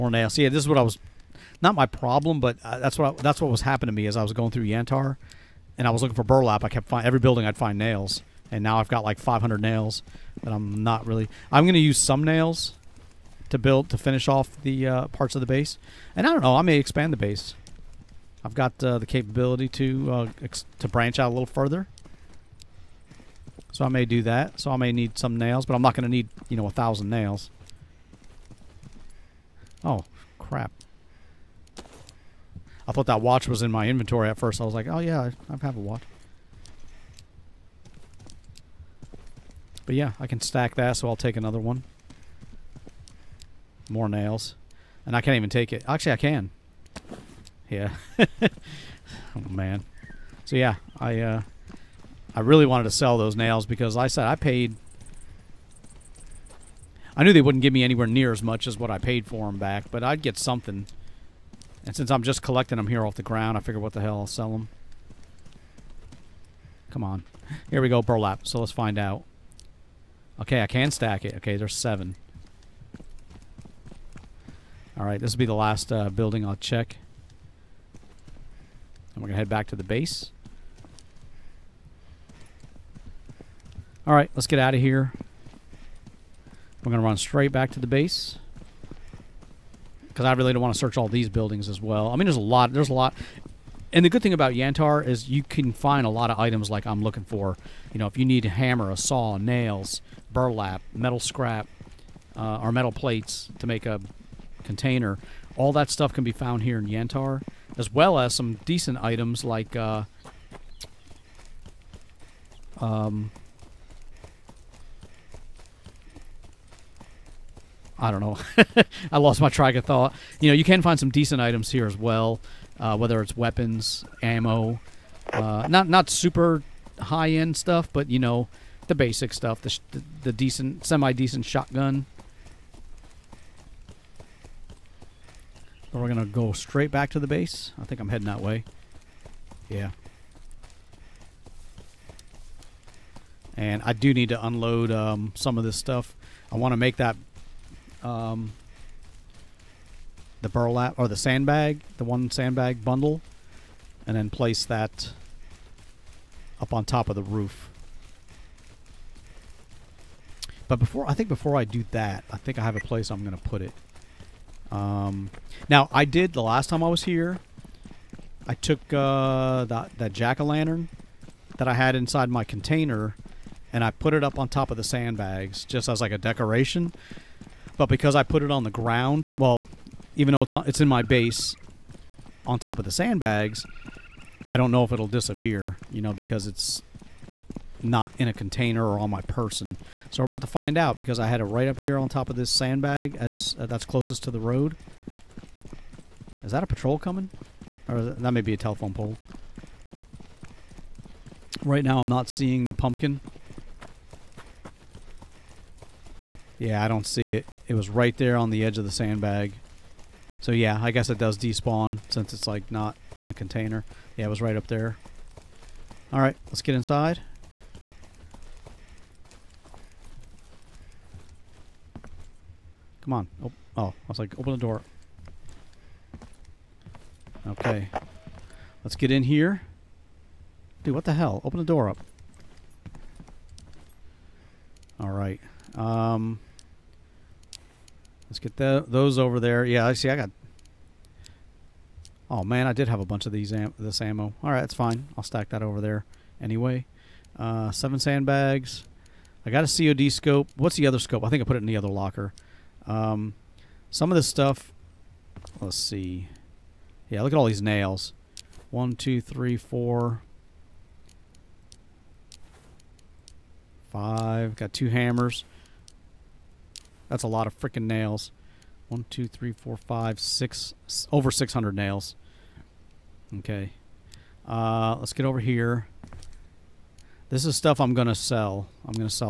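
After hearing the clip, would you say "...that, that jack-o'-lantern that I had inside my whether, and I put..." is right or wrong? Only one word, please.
wrong.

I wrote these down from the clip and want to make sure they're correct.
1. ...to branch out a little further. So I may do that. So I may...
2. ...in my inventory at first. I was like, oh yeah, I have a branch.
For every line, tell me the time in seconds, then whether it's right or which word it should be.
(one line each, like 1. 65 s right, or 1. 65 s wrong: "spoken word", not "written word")
1. 20 s right
2. 33 s wrong: "watch", not "branch".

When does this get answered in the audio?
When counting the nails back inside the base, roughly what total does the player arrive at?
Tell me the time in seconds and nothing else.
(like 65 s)
271 s.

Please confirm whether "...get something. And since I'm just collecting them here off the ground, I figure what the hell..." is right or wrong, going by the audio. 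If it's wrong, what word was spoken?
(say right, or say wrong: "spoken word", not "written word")
right.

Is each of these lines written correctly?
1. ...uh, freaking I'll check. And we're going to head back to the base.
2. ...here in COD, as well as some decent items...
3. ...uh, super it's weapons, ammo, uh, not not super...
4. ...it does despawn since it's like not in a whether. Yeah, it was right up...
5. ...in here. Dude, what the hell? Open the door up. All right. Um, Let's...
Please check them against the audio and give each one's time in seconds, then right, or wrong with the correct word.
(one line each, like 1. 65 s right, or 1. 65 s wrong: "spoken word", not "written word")
1. 75 s wrong: "building", not "freaking"
2. 106 s wrong: "Yantar", not "COD"
3. 122 s wrong: "whether", not "super"
4. 211 s wrong: "container", not "whether"
5. 229 s right.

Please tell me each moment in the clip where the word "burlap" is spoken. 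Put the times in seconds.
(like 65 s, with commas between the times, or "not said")
6 s, 68 s, 100 s, 150 s.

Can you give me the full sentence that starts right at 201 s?
Right now I'm not seeing the pumpkin.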